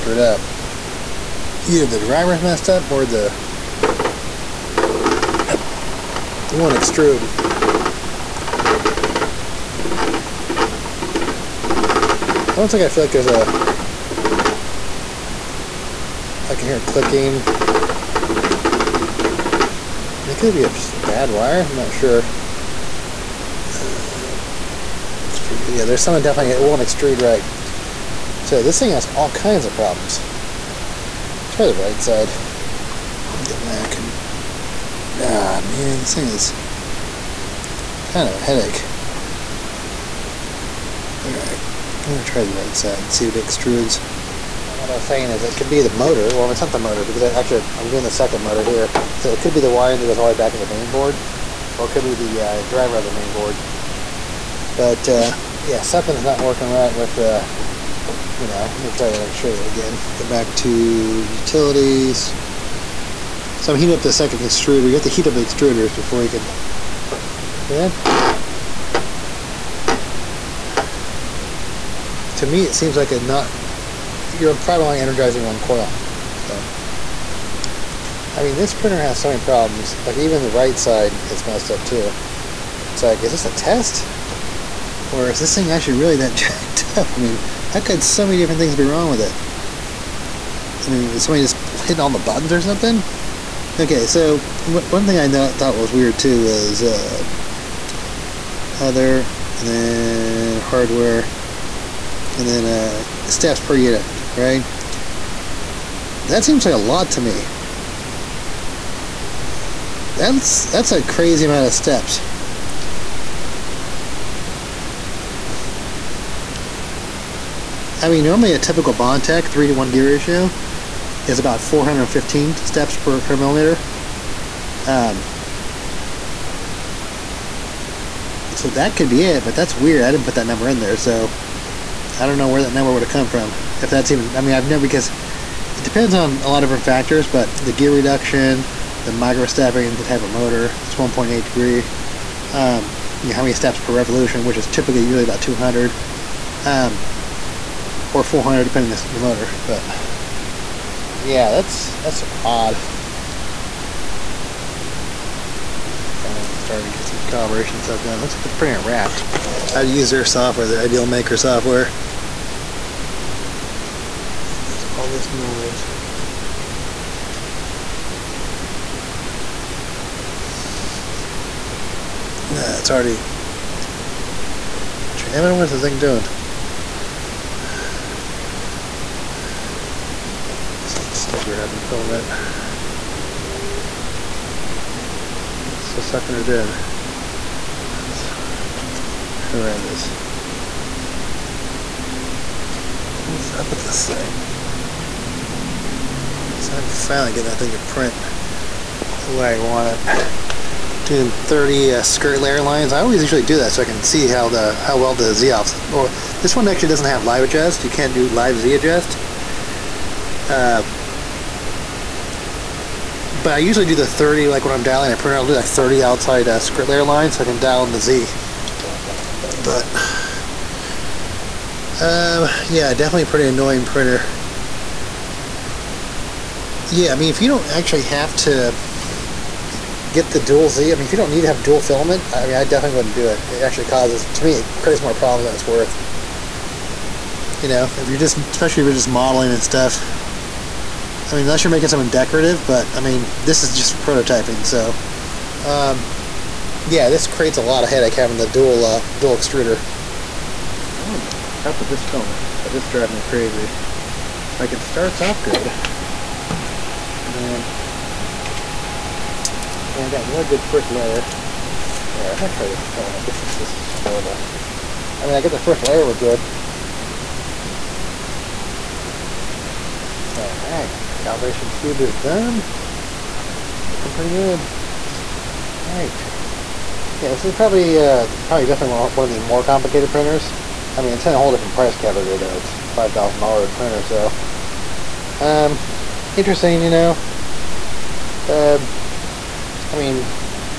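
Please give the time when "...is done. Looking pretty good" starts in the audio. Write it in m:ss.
4:31.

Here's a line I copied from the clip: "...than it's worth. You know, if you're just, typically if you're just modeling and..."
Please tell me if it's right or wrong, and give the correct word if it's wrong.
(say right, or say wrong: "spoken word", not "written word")
wrong: "especially", not "typically".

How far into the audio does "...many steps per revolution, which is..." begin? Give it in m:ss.
2:23.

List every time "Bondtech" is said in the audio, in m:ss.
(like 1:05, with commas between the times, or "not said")
1:58.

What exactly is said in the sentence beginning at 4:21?
There, I'm going to try to film it.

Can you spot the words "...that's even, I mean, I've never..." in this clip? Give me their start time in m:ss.
2:13.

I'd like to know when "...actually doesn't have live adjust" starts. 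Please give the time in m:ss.
3:26.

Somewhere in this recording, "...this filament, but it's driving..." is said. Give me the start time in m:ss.
4:11.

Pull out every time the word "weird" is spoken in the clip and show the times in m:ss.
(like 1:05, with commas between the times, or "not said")
1:35, 2:09.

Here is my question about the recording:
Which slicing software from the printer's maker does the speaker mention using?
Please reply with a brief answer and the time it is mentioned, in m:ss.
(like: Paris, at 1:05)
ideaMaker, at 2:40.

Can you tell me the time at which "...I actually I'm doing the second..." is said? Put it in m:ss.
0:47.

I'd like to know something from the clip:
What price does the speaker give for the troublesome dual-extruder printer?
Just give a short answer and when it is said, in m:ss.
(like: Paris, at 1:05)
$5,000, at 4:42.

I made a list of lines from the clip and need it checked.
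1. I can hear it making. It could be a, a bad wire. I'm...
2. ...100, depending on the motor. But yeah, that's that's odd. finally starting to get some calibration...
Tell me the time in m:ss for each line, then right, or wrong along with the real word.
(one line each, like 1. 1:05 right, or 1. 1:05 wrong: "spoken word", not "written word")
1. 0:16 wrong: "clicking", not "making"
2. 2:28 wrong: "400", not "100".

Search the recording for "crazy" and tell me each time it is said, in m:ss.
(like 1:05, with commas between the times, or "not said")
1:51, 4:13.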